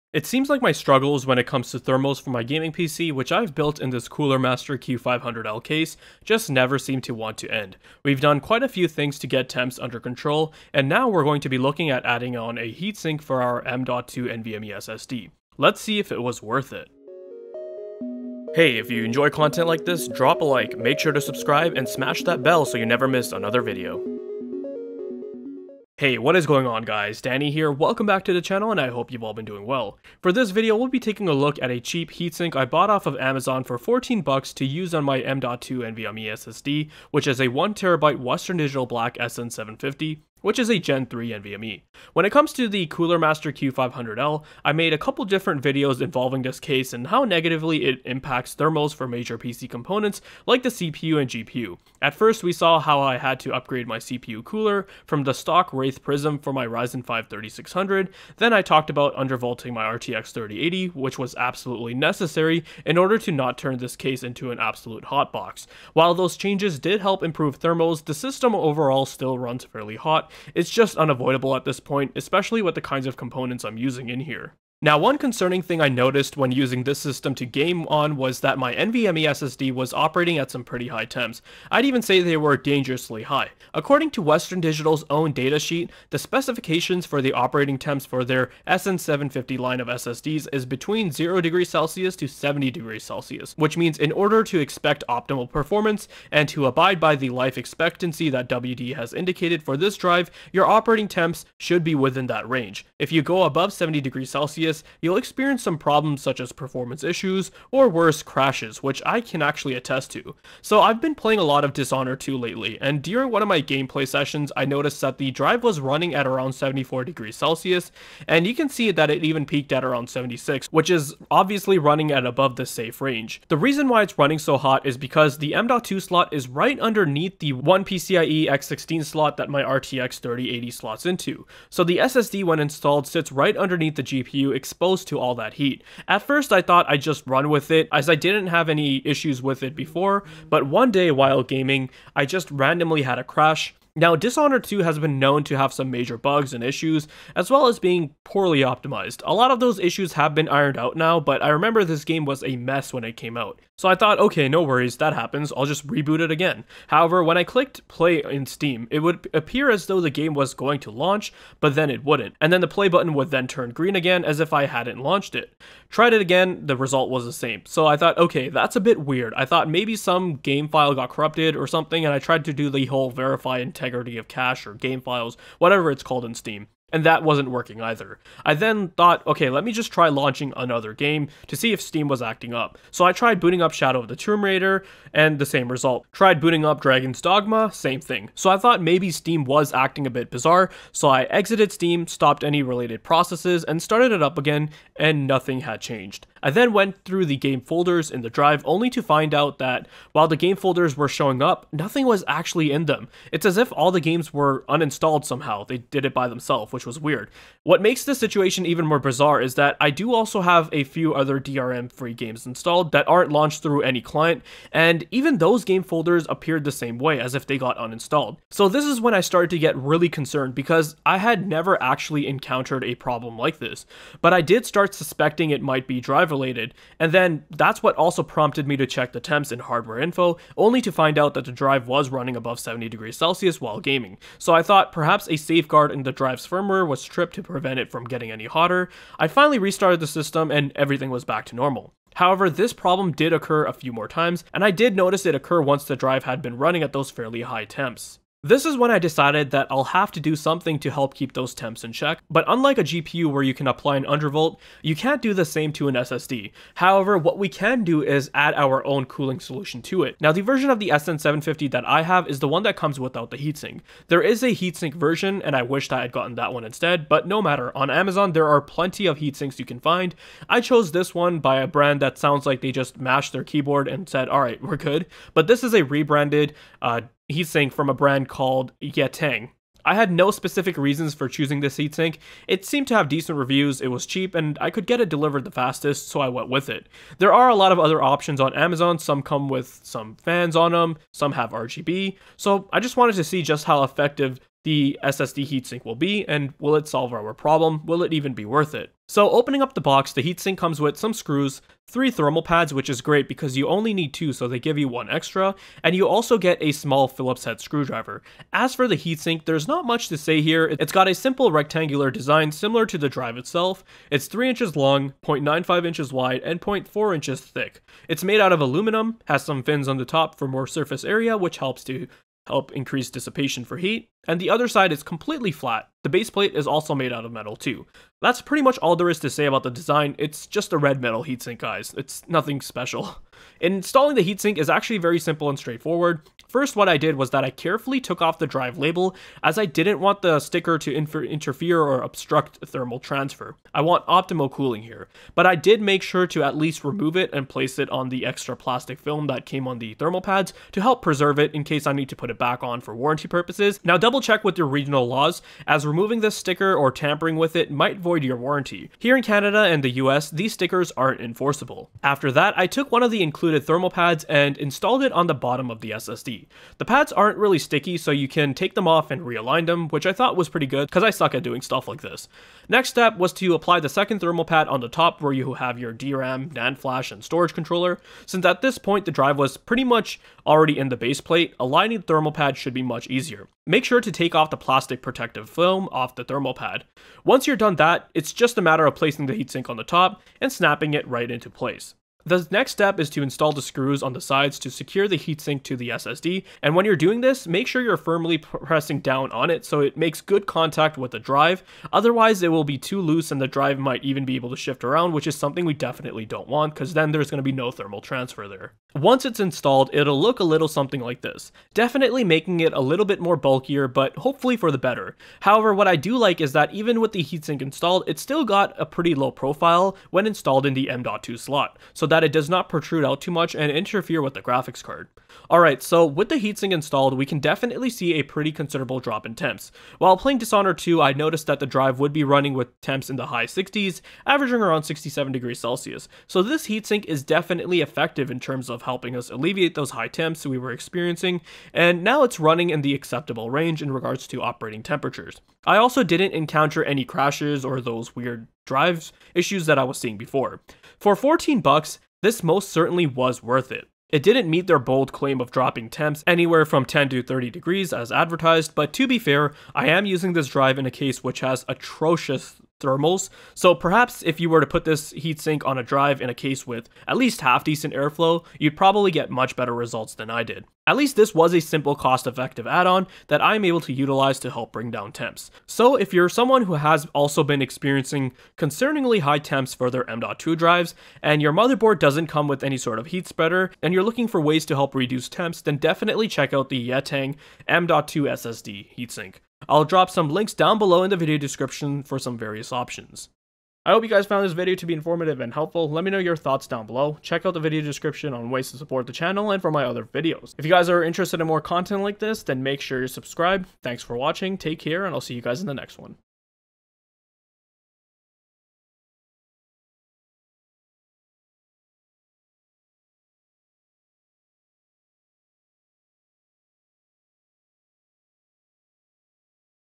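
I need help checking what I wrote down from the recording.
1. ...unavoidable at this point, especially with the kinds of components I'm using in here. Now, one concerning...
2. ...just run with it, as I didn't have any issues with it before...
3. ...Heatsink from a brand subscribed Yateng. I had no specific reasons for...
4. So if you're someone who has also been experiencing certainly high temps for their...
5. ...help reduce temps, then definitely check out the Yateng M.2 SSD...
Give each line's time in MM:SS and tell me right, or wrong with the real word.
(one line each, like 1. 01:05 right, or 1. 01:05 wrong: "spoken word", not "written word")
1. 01:10 right
2. 02:17 right
3. 04:37 wrong: "called", not "subscribed"
4. 07:55 wrong: "concerningly", not "certainly"
5. 08:04 right.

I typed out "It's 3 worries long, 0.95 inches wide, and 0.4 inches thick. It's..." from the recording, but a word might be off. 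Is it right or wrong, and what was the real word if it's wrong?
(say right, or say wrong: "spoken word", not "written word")
wrong: "inches", not "worries".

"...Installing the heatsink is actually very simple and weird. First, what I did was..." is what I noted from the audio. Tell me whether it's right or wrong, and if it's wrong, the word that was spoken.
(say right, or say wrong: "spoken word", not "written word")
wrong: "straightforward", not "weird".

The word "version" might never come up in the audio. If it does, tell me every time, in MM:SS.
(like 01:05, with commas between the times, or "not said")
04:20, 04:24.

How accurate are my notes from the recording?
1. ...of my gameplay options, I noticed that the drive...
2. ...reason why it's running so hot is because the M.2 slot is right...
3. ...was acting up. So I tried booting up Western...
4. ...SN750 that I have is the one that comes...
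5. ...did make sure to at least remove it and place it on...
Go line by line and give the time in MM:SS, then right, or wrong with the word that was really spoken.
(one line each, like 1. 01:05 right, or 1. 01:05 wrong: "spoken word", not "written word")
1. 01:53 wrong: "sessions", not "options"
2. 02:03 right
3. 03:02 wrong: "Shadow", not "Western"
4. 04:20 right
5. 05:45 right.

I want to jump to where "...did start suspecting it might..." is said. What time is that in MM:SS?
03:44.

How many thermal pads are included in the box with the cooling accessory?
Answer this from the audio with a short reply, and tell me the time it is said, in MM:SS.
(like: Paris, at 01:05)
3, at 05:01.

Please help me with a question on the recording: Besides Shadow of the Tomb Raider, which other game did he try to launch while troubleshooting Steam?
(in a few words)
Dragon's Dogma.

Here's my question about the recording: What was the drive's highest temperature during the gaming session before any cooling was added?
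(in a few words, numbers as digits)
76.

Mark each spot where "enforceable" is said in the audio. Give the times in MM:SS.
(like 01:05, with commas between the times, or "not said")
06:01.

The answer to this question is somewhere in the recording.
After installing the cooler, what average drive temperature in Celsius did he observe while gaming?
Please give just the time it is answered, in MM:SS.
07:14.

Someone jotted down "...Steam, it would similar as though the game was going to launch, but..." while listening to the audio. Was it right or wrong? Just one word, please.
wrong.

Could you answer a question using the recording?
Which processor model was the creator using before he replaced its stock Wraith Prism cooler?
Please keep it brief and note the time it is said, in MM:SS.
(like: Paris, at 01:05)
Ryzen 5 3600, at 00:56.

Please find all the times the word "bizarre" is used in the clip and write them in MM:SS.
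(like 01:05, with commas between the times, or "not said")
03:10, 03:28.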